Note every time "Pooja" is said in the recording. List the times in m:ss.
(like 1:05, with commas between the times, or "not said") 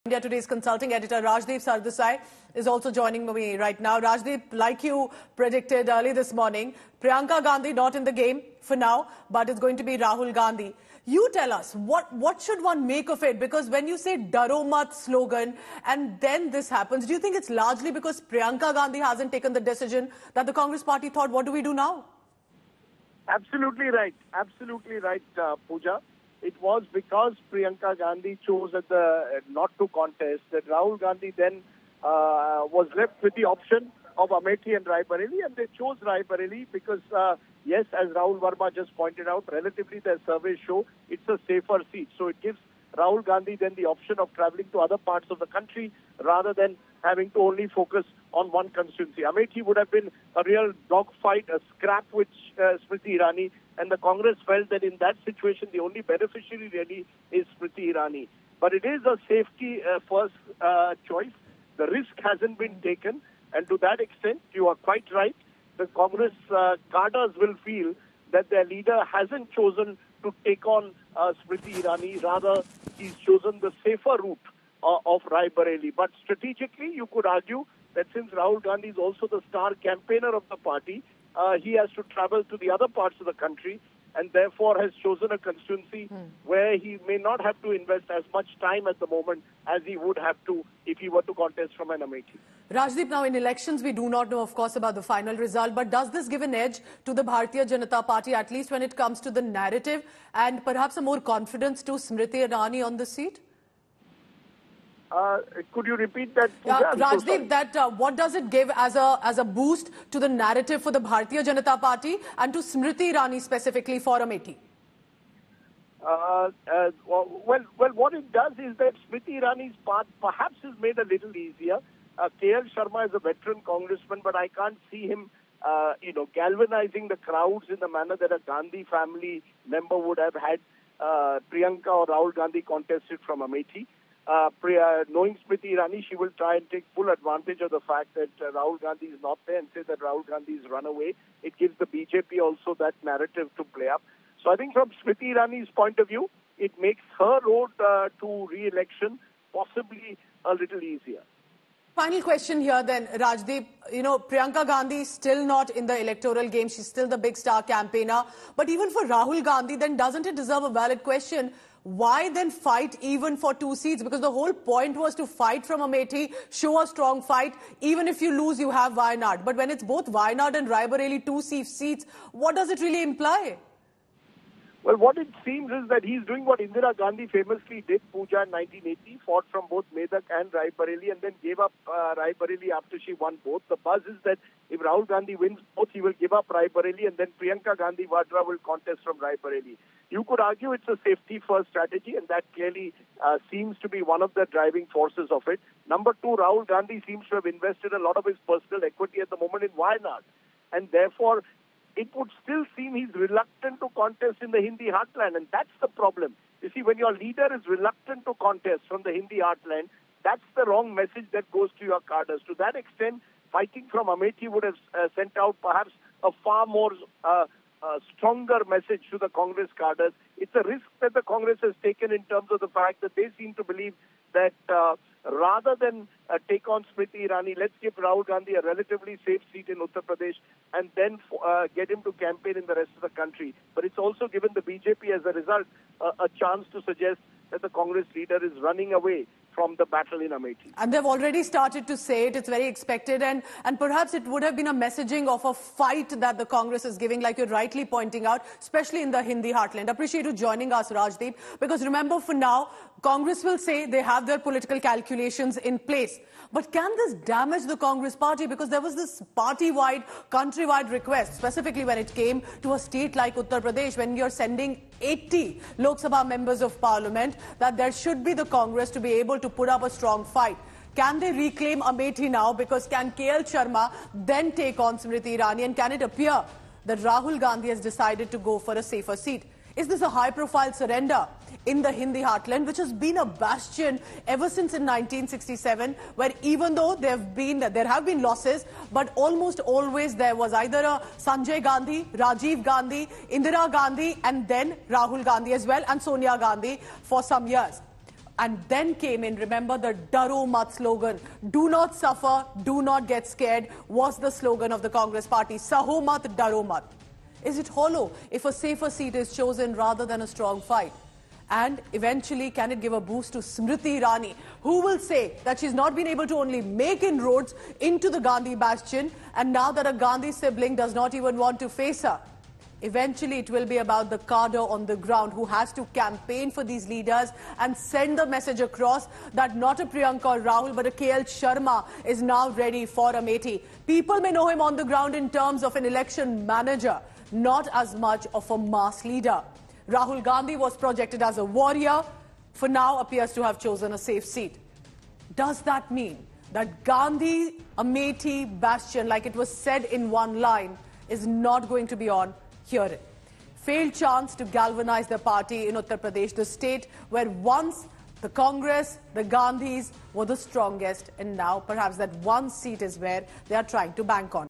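0:25, 1:46, 2:58.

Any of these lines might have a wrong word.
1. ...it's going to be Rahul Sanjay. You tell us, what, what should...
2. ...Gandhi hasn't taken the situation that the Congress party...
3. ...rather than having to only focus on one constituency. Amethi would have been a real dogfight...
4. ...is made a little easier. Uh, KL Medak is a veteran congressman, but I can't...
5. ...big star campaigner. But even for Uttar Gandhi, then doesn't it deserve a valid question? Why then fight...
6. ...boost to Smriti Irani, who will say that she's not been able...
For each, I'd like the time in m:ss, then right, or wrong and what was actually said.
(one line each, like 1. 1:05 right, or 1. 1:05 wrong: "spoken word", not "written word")
1. 0:09 wrong: "Gandhi", not "Sanjay"
2. 0:18 wrong: "decision", not "situation"
3. 0:46 right
4. 2:00 wrong: "Sharma", not "Medak"
5. 2:37 wrong: "Rahul", not "Uttar"
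6. 5:13 right.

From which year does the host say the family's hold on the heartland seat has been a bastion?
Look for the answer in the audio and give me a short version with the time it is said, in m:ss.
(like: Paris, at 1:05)
1967, at 4:44.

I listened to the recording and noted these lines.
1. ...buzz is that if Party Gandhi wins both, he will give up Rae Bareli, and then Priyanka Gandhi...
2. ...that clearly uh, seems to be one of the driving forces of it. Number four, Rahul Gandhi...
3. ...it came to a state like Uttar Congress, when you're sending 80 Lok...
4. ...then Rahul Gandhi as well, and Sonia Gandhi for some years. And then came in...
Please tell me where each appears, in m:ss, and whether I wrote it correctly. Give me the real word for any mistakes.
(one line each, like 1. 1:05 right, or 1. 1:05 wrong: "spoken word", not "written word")
1. 3:03 wrong: "Rahul", not "Party"
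2. 3:12 wrong: "two", not "four"
3. 4:21 wrong: "Pradesh", not "Congress"
4. 4:54 right.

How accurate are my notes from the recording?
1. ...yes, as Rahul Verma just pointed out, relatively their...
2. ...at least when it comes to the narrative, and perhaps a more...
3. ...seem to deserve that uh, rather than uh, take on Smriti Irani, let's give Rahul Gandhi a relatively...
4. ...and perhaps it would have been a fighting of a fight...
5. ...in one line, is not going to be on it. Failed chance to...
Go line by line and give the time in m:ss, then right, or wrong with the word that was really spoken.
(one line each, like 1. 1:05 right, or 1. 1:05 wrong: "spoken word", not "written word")
1. 0:37 right
2. 1:38 right
3. 3:43 wrong: "believe", not "deserve"
4. 4:03 wrong: "messaging", not "fighting"
5. 5:49 right.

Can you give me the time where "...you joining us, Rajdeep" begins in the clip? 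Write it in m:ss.
4:10.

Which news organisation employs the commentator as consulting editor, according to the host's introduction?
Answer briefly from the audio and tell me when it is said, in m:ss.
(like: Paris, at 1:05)
India Today, at 0:00.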